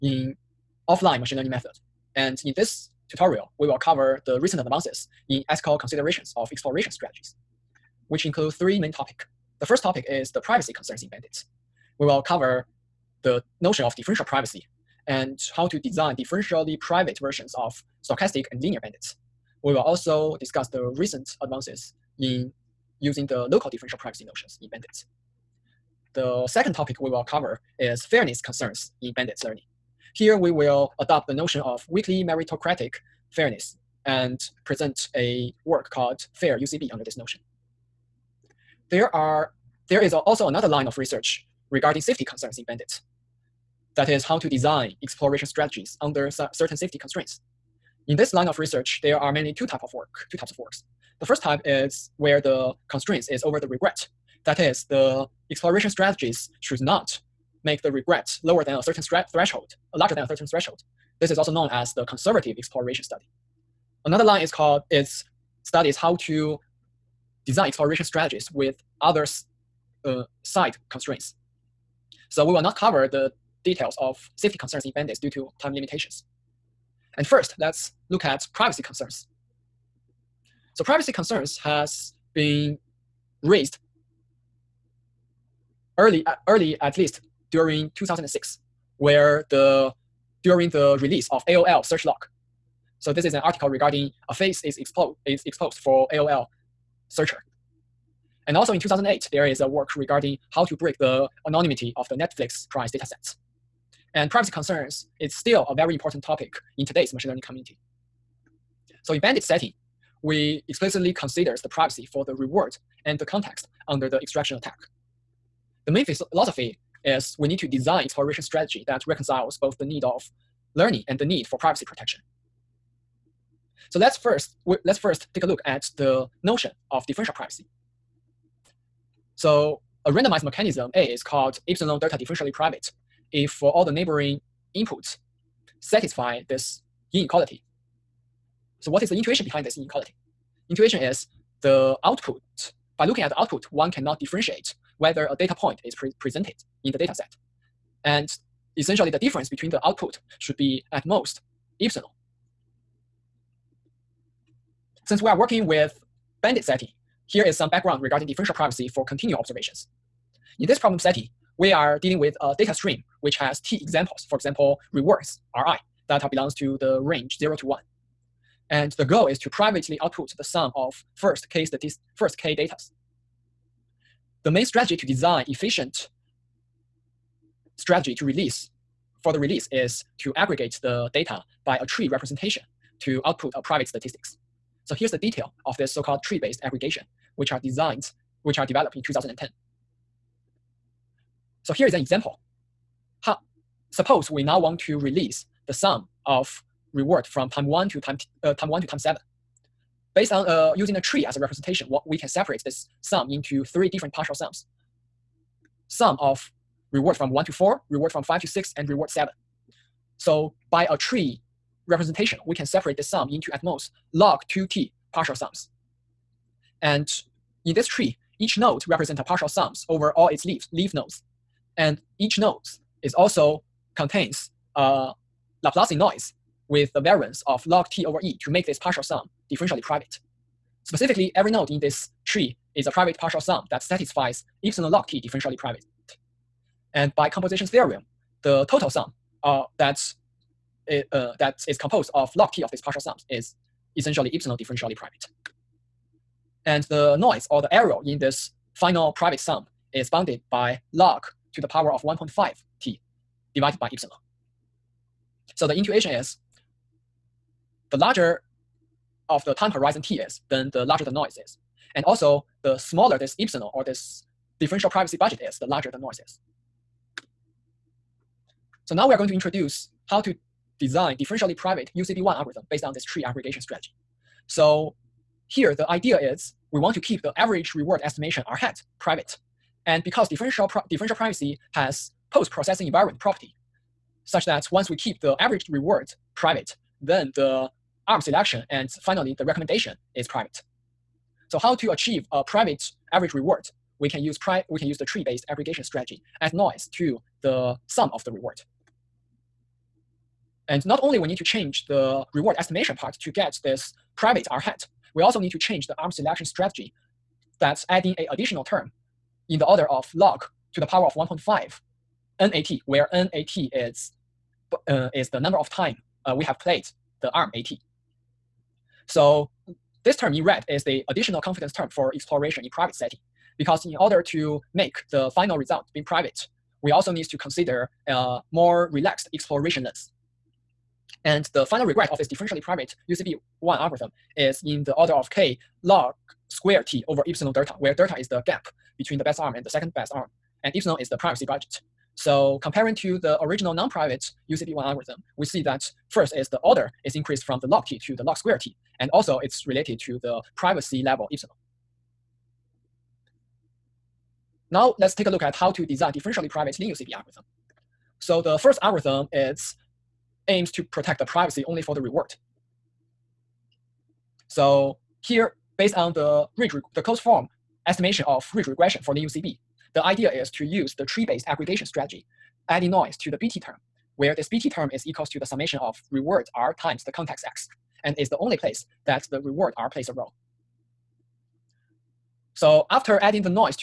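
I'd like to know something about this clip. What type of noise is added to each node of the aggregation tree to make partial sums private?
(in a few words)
Laplacian noise.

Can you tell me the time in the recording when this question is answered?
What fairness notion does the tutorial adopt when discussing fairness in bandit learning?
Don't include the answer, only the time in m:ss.
0:31.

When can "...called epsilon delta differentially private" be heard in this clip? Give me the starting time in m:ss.
2:11.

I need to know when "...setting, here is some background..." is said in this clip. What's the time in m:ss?
2:36.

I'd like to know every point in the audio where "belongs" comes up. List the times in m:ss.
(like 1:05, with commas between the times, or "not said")
2:46.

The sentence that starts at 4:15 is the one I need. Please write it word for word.
So the intuition is the larger of the time horizon t is, then the larger the noise is.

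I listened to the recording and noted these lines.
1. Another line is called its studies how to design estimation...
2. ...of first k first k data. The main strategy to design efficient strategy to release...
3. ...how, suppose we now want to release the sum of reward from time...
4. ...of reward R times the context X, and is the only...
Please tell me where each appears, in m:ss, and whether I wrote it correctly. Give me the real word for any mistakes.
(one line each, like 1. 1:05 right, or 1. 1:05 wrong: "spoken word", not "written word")
1. 1:04 wrong: "exploration", not "estimation"
2. 2:50 right
3. 3:13 right
4. 6:15 right.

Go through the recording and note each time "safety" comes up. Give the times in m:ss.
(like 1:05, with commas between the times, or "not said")
0:42, 0:46, 1:14.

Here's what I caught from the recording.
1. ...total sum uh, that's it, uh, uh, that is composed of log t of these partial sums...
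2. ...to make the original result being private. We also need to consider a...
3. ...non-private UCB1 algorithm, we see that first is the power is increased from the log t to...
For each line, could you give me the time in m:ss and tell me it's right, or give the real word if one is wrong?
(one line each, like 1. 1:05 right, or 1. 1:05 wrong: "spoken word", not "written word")
1. 3:58 right
2. 5:24 wrong: "final", not "original"
3. 5:43 wrong: "order", not "power".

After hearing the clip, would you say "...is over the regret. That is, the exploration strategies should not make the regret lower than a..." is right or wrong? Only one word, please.
right.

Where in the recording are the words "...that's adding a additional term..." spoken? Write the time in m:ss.
5:07.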